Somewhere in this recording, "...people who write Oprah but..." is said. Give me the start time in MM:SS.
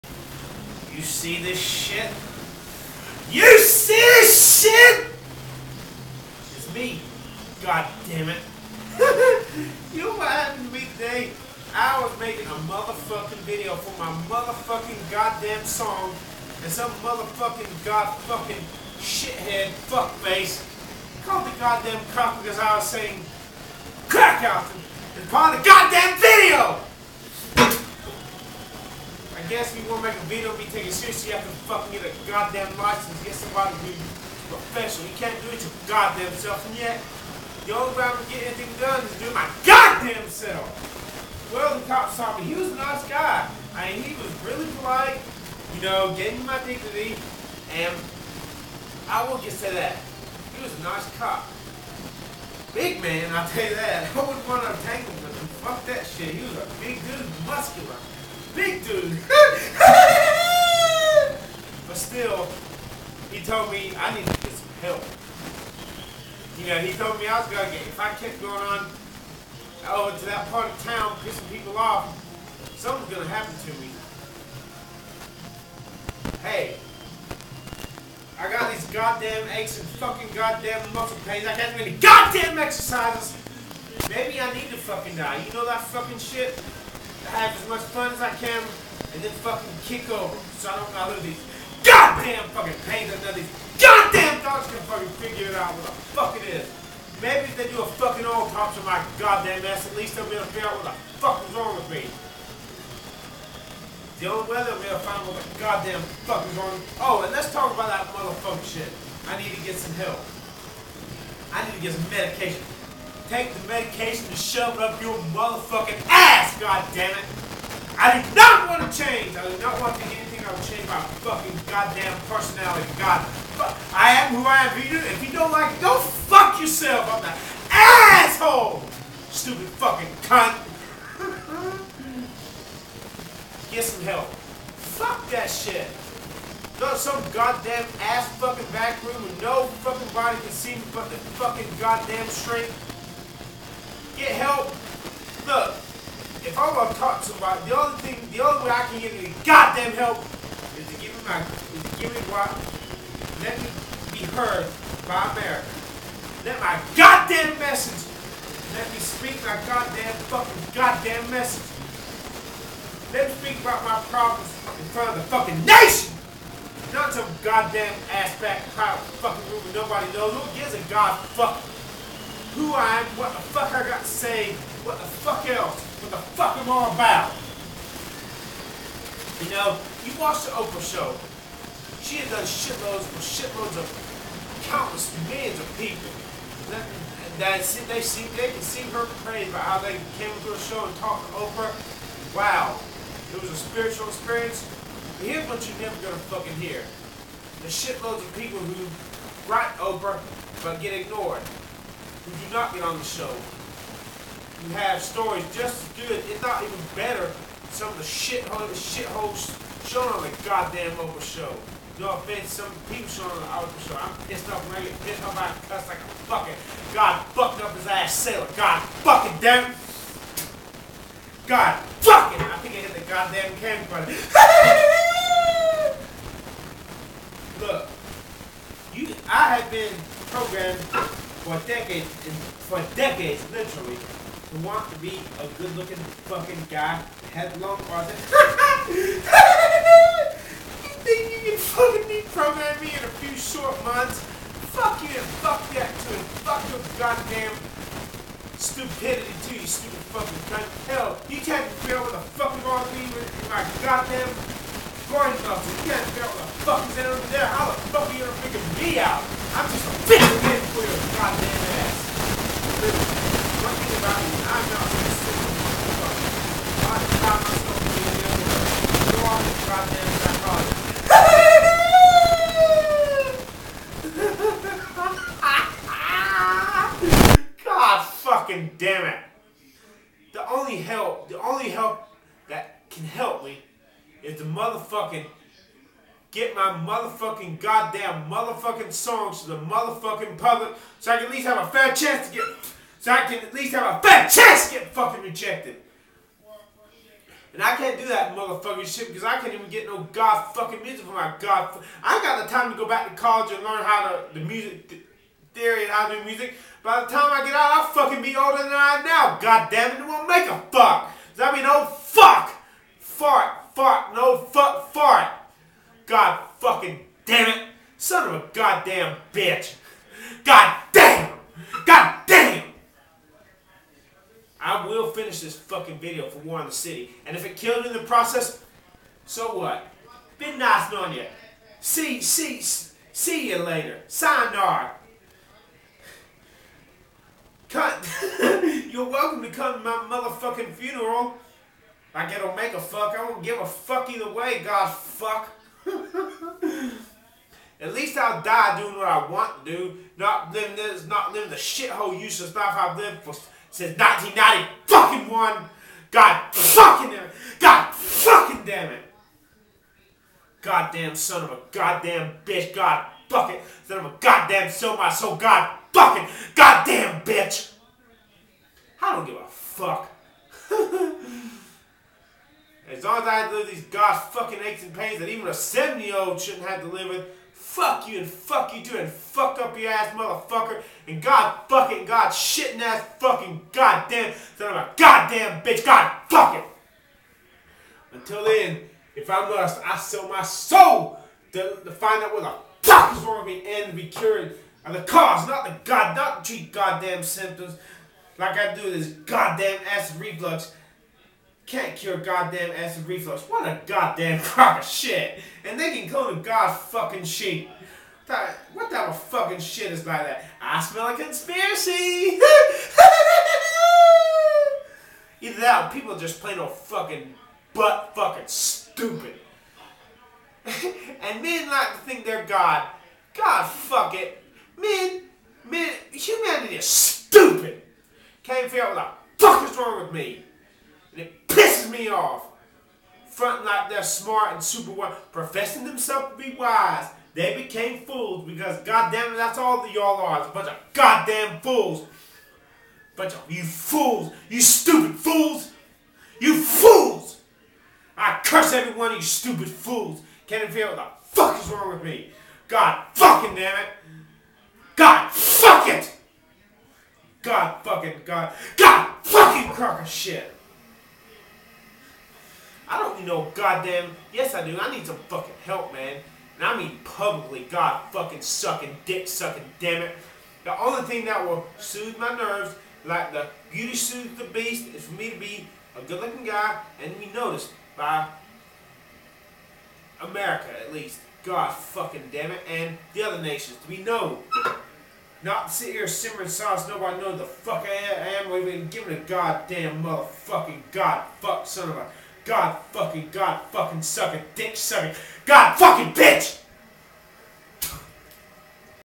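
03:18.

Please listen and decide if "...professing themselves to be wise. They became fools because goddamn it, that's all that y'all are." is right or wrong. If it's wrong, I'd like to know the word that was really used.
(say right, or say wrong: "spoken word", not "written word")
right.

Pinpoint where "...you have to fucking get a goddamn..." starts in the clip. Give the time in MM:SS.
00:31.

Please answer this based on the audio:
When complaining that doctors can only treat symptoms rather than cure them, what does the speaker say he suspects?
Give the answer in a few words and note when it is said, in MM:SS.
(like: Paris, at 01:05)
A conspiracy, at 06:51.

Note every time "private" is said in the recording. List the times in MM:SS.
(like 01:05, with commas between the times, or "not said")
not said.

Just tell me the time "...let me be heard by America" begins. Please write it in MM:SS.
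02:33.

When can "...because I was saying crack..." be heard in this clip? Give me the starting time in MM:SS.
00:22.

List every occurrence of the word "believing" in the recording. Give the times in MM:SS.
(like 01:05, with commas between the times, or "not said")
not said.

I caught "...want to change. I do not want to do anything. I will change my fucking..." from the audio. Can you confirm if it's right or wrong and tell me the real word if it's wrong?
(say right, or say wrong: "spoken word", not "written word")
right.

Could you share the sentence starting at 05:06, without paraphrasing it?
By the time I get out, I'll fucking be older than I am now.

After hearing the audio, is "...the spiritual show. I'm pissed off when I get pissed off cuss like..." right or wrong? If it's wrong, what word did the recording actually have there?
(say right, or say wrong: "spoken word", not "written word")
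wrong: "local", not "spiritual".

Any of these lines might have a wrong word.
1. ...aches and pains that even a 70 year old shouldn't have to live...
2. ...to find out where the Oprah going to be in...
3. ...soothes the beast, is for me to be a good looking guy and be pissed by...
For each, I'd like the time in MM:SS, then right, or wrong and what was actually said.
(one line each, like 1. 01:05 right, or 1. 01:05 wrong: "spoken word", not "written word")
1. 06:14 right
2. 06:31 wrong: "Doctors", not "Oprah"
3. 07:53 wrong: "noticed", not "pissed".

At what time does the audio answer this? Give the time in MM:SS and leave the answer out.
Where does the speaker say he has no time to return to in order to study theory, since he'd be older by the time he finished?
05:03.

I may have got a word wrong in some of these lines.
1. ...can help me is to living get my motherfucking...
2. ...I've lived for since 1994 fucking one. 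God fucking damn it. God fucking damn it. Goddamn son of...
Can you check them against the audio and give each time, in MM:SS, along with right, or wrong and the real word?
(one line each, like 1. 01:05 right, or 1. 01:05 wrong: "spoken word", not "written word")
1. 04:42 wrong: "motherfucking", not "living"
2. 05:52 wrong: "1990", not "1994".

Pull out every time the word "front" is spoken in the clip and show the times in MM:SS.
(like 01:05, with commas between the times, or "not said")
02:44, 07:13.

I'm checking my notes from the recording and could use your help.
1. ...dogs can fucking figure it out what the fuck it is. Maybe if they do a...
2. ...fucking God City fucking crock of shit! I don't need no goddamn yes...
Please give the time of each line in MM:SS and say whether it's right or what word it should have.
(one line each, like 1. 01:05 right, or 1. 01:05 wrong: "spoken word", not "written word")
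1. 01:34 right
2. 07:37 wrong: "God", not "City".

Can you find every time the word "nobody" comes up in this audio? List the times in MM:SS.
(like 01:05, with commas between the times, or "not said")
02:49, 08:06.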